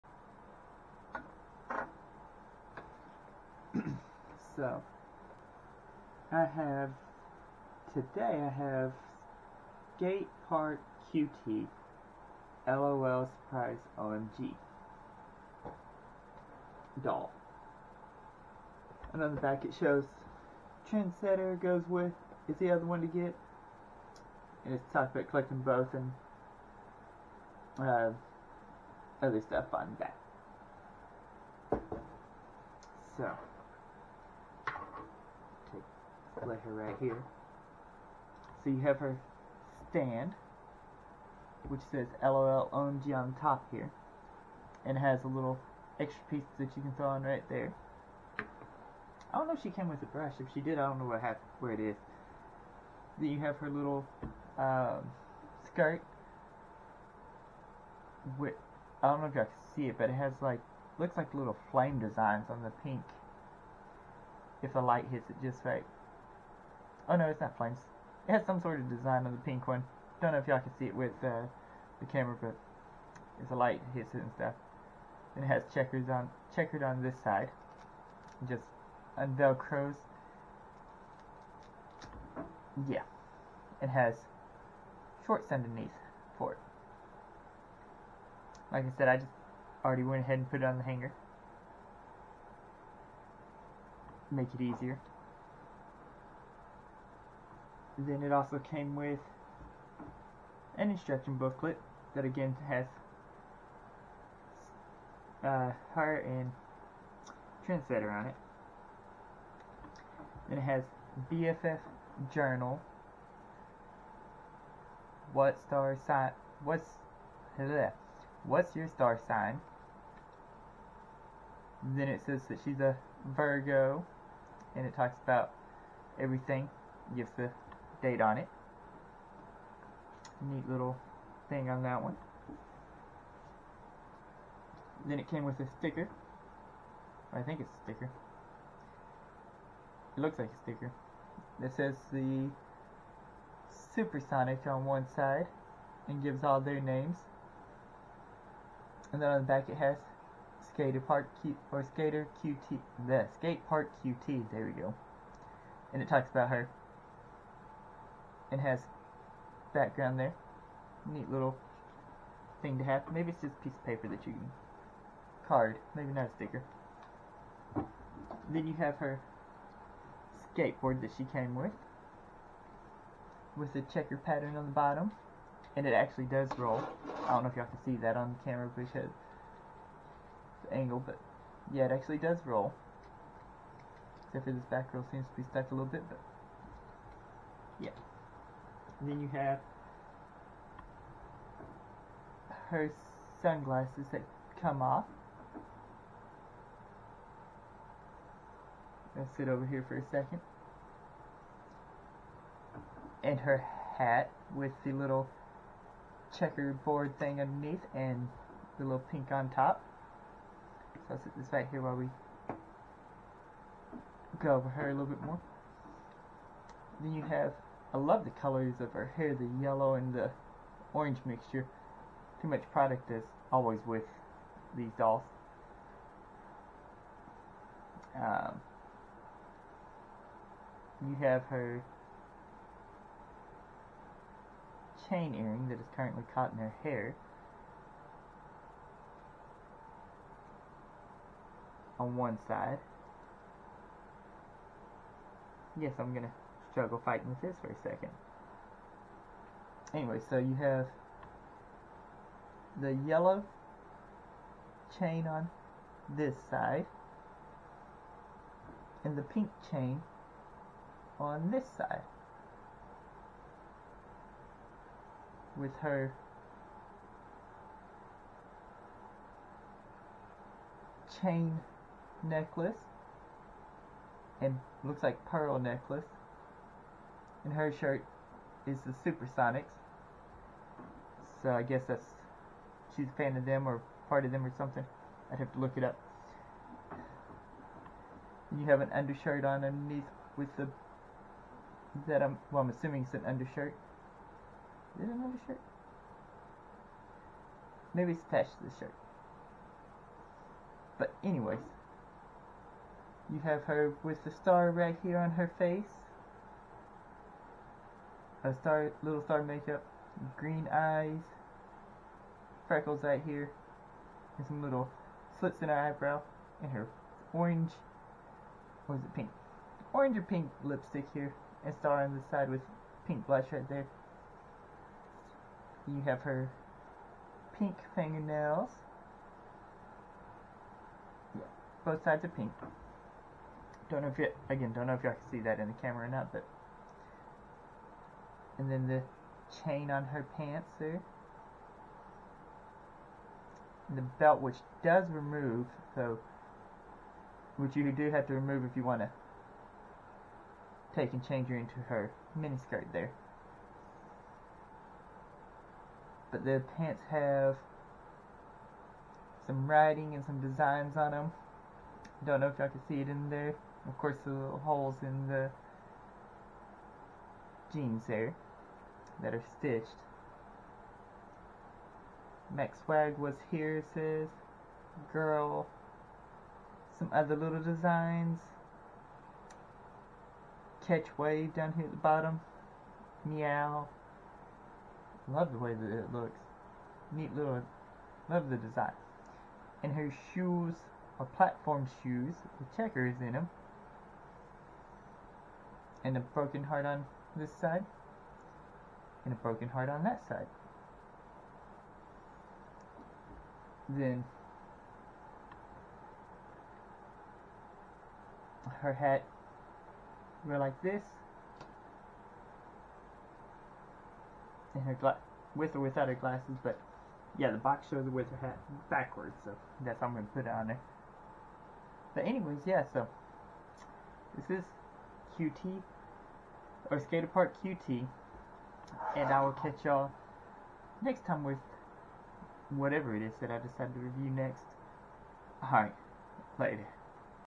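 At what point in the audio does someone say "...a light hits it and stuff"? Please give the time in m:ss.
1:13.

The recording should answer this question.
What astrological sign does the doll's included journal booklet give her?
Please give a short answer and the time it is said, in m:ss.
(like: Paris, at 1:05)
Virgo, at 2:03.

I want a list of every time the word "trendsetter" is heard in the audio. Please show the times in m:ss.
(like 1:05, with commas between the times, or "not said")
0:20, 1:47.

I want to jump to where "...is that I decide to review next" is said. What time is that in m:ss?
7:13.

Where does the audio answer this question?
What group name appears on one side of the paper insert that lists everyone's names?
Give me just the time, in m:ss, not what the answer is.
2:23.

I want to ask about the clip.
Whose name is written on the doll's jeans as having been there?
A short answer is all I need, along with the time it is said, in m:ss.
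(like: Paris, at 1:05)
Max Swag, at 6:12.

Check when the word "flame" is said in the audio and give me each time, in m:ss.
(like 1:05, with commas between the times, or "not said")
1:01, 1:07.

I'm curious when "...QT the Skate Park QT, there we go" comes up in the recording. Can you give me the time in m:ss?
2:32.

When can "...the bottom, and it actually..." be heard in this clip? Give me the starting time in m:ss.
2:54.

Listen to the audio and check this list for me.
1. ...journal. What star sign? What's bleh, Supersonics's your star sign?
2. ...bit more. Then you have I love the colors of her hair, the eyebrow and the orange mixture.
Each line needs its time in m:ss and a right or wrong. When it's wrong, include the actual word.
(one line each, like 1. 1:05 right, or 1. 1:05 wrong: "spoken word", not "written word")
1. 1:52 wrong: "What", not "Supersonics"
2. 3:35 wrong: "yellow", not "eyebrow".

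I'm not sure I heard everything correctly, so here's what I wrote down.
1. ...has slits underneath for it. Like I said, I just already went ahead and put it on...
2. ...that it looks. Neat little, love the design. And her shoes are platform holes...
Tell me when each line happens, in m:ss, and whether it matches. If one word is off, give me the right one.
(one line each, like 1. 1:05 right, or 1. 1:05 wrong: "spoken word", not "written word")
1. 1:23 wrong: "shorts", not "slits"
2. 6:25 wrong: "shoes", not "holes".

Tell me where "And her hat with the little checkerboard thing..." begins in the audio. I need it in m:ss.
3:23.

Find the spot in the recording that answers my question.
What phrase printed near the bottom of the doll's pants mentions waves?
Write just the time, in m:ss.
6:20.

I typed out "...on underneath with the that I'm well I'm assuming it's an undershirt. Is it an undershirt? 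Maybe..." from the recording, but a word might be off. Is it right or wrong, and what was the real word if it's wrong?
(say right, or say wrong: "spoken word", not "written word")
right.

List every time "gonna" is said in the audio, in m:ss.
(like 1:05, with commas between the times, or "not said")
4:06, 7:00.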